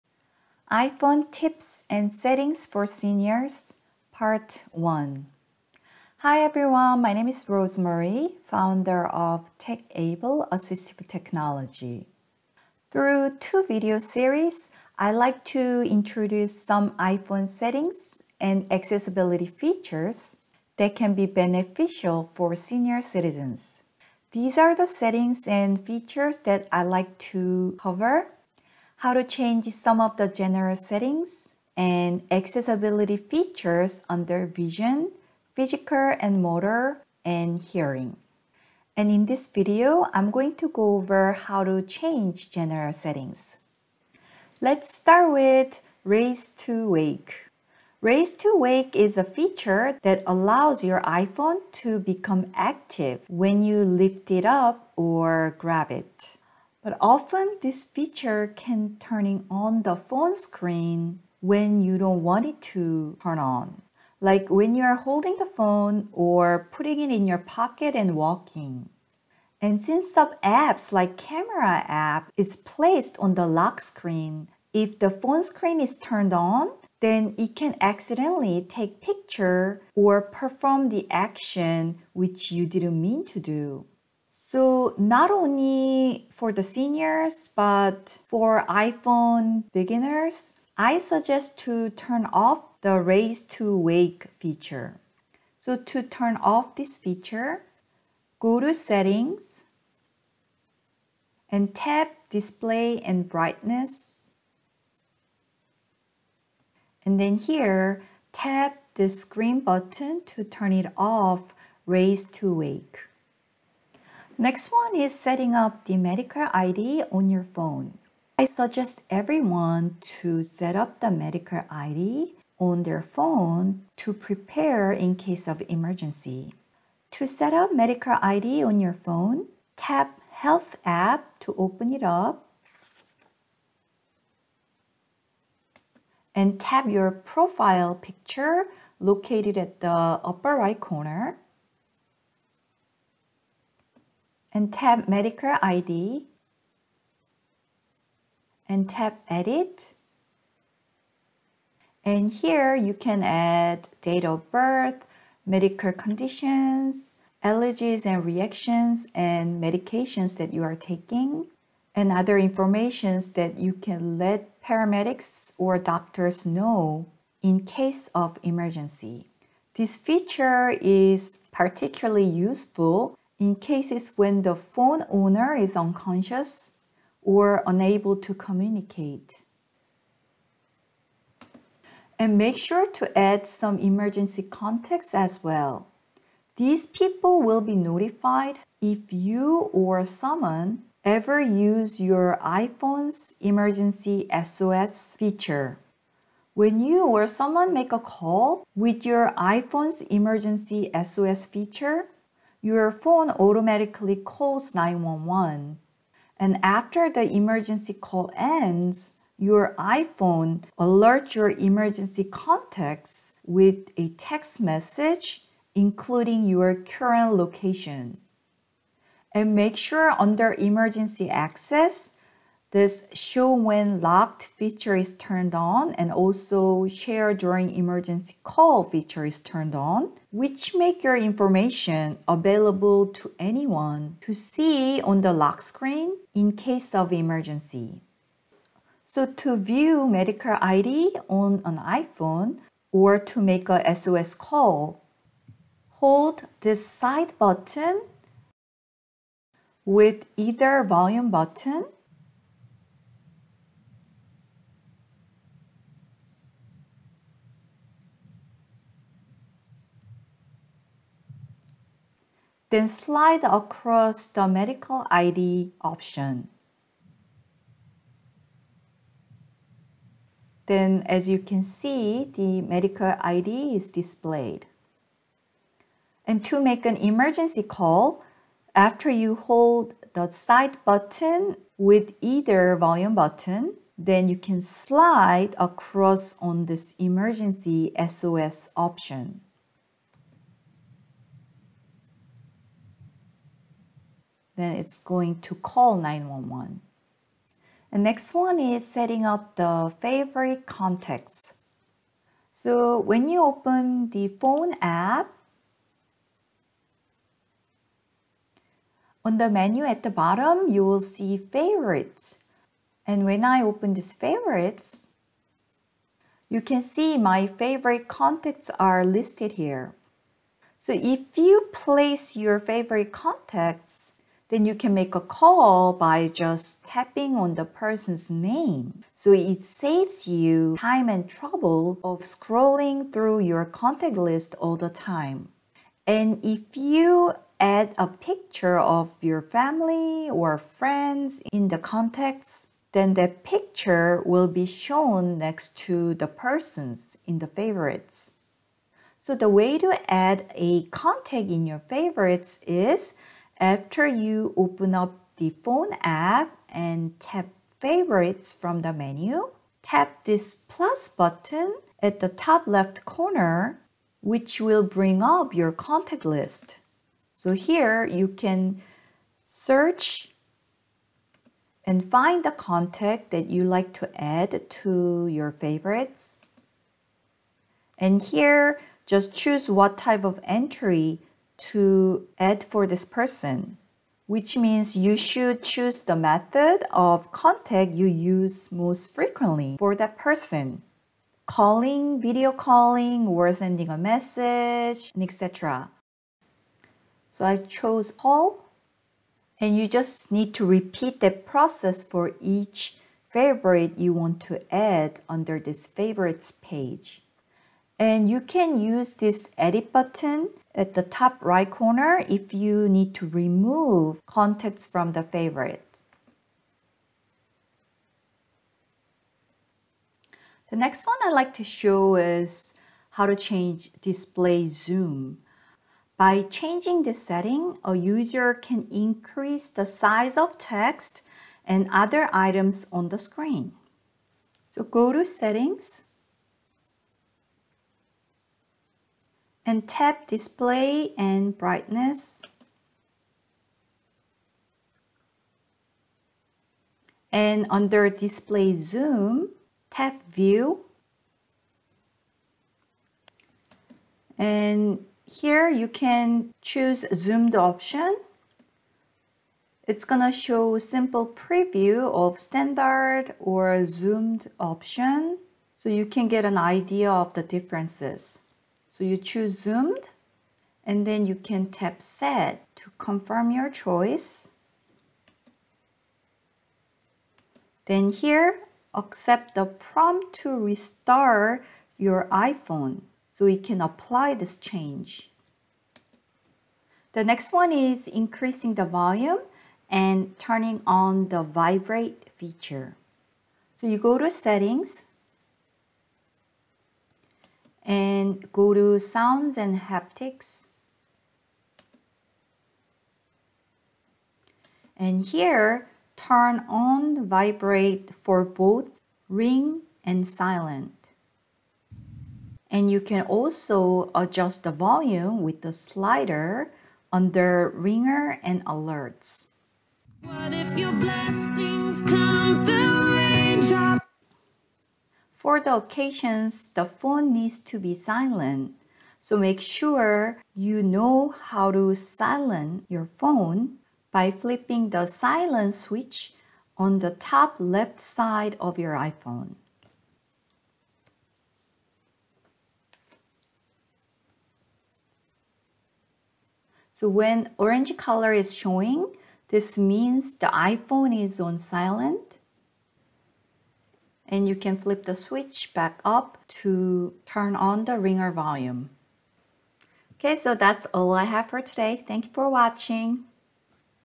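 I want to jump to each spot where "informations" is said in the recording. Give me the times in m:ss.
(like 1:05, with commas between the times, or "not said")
2:42, 3:51.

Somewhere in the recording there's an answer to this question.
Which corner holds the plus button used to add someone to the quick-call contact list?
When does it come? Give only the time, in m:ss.
6:02.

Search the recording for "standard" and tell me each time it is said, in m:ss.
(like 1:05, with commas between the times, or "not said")
7:42.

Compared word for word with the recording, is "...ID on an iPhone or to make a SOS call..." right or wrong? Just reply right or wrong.
right.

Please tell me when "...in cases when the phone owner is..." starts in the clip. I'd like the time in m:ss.
2:53.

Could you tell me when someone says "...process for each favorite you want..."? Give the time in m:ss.
6:41.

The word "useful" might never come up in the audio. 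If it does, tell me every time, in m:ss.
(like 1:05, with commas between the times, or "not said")
2:52.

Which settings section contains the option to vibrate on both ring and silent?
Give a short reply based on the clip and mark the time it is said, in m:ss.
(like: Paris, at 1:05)
Sounds and Haptics, at 8:18.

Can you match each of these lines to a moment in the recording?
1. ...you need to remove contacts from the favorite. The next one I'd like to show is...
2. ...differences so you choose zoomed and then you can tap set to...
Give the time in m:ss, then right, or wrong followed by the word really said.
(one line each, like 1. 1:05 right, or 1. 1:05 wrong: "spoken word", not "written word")
1. 6:52 right
2. 7:47 right.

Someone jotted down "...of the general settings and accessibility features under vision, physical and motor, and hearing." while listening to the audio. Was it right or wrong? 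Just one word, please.
right.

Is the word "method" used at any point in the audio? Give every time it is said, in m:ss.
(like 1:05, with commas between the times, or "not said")
6:26.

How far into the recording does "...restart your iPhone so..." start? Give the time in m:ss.
8:00.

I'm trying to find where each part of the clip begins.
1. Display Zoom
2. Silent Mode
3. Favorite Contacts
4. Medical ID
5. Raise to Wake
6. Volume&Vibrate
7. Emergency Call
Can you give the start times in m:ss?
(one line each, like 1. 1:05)
1. 7:00
2. 8:45
3. 4:57
4. 1:54
5. 0:44
6. 8:06
7. 3:59.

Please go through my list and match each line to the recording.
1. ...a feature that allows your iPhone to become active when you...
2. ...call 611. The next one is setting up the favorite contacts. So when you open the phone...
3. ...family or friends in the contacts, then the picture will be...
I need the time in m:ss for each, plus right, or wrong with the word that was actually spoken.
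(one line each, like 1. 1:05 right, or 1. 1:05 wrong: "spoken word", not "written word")
1. 0:49 right
2. 4:55 wrong: "911", not "611"
3. 5:39 right.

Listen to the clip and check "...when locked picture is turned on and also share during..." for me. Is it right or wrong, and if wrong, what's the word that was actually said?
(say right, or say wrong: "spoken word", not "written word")
wrong: "feature", not "picture".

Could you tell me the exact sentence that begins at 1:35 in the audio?
So to turn off this feature, go to settings and tap display and brightness.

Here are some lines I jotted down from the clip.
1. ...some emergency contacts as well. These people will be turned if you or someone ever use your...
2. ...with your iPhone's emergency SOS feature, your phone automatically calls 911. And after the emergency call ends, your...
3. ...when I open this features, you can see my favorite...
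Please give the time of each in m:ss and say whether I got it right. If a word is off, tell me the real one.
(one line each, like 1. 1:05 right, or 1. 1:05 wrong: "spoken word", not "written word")
1. 3:03 wrong: "notified", not "turned"
2. 3:18 right
3. 5:13 wrong: "favorites", not "features".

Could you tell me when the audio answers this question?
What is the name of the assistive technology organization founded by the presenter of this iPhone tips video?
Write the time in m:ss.
0:09.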